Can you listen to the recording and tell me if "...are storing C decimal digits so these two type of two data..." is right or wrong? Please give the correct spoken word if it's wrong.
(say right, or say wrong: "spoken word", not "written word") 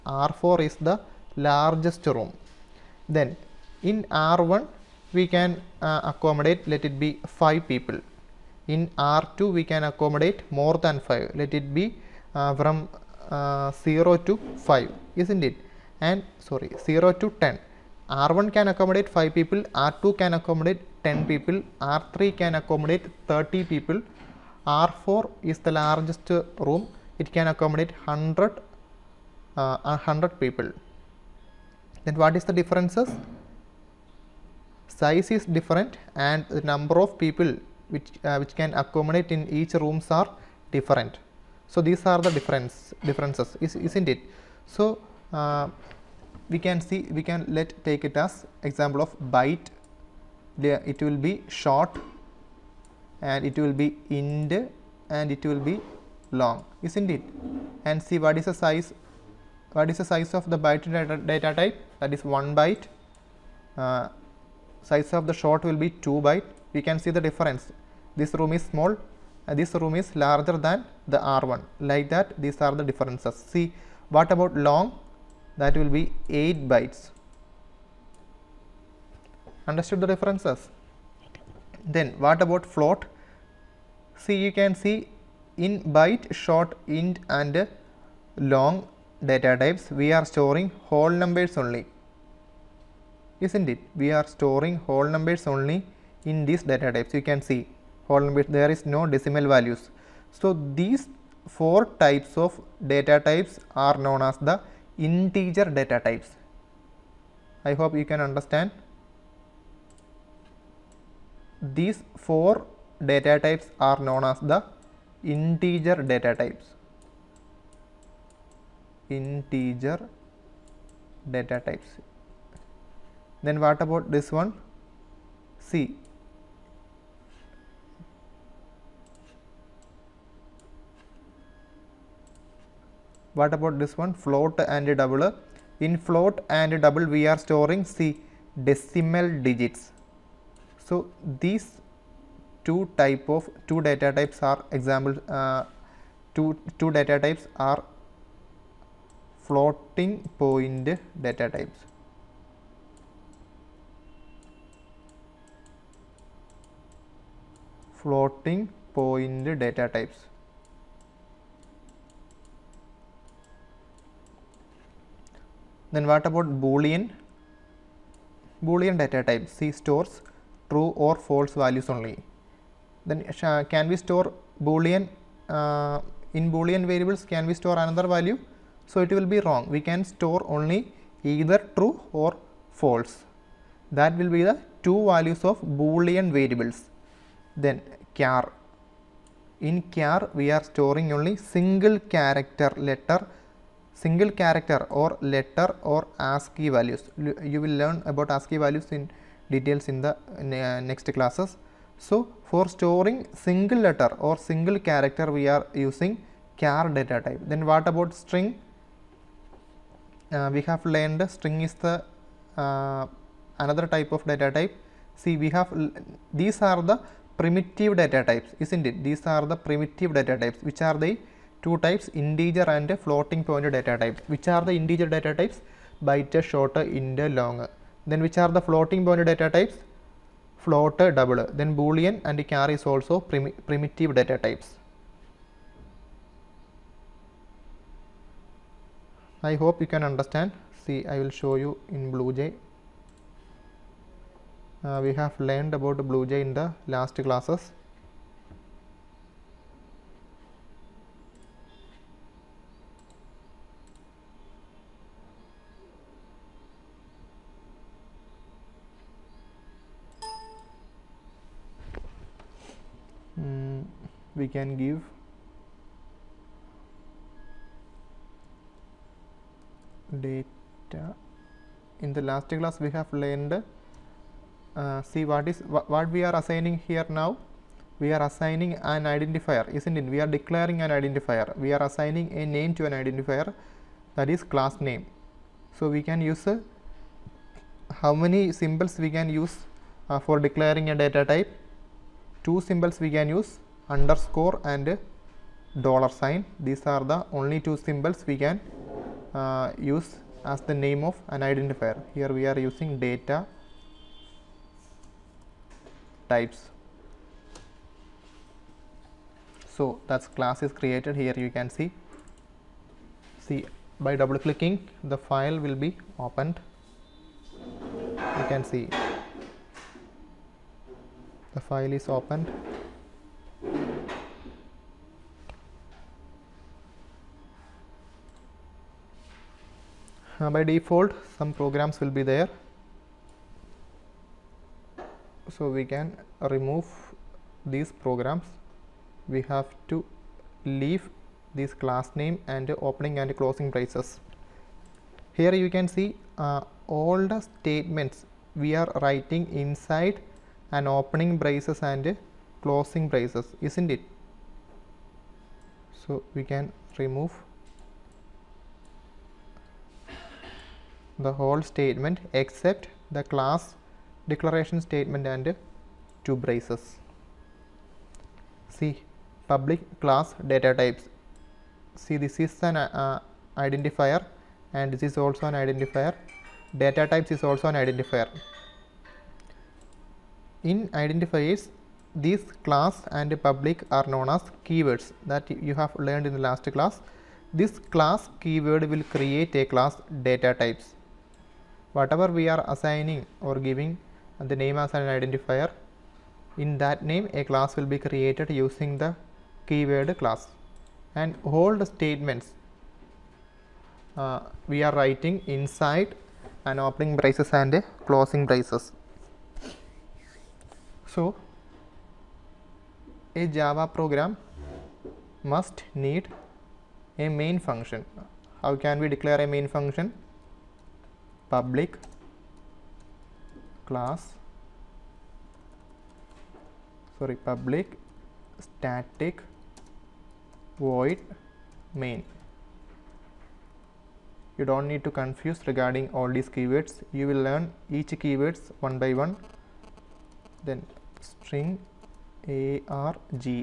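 right.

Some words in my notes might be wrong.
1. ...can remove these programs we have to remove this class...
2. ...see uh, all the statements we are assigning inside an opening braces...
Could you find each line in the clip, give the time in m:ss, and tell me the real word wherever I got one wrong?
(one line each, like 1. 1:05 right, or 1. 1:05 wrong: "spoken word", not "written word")
1. 5:35 wrong: "leave", not "remove"
2. 5:45 wrong: "writing", not "assigning".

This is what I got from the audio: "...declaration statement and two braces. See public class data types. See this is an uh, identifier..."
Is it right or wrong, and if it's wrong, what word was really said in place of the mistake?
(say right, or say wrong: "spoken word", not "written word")
right.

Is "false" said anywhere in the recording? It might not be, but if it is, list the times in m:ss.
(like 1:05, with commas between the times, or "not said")
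2:51, 3:02.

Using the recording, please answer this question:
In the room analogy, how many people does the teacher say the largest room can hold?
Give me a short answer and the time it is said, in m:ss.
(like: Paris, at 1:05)
100, at 0:27.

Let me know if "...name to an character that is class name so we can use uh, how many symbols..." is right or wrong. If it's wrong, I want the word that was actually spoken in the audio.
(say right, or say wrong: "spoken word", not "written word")
wrong: "identifier", not "character".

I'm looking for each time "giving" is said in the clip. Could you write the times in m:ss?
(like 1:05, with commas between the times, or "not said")
6:33.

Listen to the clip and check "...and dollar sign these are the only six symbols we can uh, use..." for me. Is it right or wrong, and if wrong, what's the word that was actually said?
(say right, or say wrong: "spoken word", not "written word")
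wrong: "two", not "six".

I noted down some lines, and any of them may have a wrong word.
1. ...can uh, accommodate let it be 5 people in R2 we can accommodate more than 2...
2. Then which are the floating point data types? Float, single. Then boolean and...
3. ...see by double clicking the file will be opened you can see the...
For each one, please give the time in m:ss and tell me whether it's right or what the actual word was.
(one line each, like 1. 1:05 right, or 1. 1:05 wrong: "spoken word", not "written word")
1. 0:05 wrong: "5", not "2"
2. 3:48 wrong: "double", not "single"
3. 5:13 right.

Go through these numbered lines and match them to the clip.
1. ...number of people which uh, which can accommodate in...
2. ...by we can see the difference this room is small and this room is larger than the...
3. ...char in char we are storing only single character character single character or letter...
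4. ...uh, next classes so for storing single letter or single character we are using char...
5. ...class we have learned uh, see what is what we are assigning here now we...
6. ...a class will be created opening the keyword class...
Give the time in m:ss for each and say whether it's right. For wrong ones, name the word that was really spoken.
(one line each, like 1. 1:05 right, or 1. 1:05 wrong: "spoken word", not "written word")
1. 0:36 right
2. 1:06 right
3. 3:08 wrong: "letter", not "character"
4. 3:20 right
5. 4:32 right
6. 6:37 wrong: "using", not "opening".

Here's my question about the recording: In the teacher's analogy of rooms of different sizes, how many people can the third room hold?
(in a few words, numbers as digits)
30.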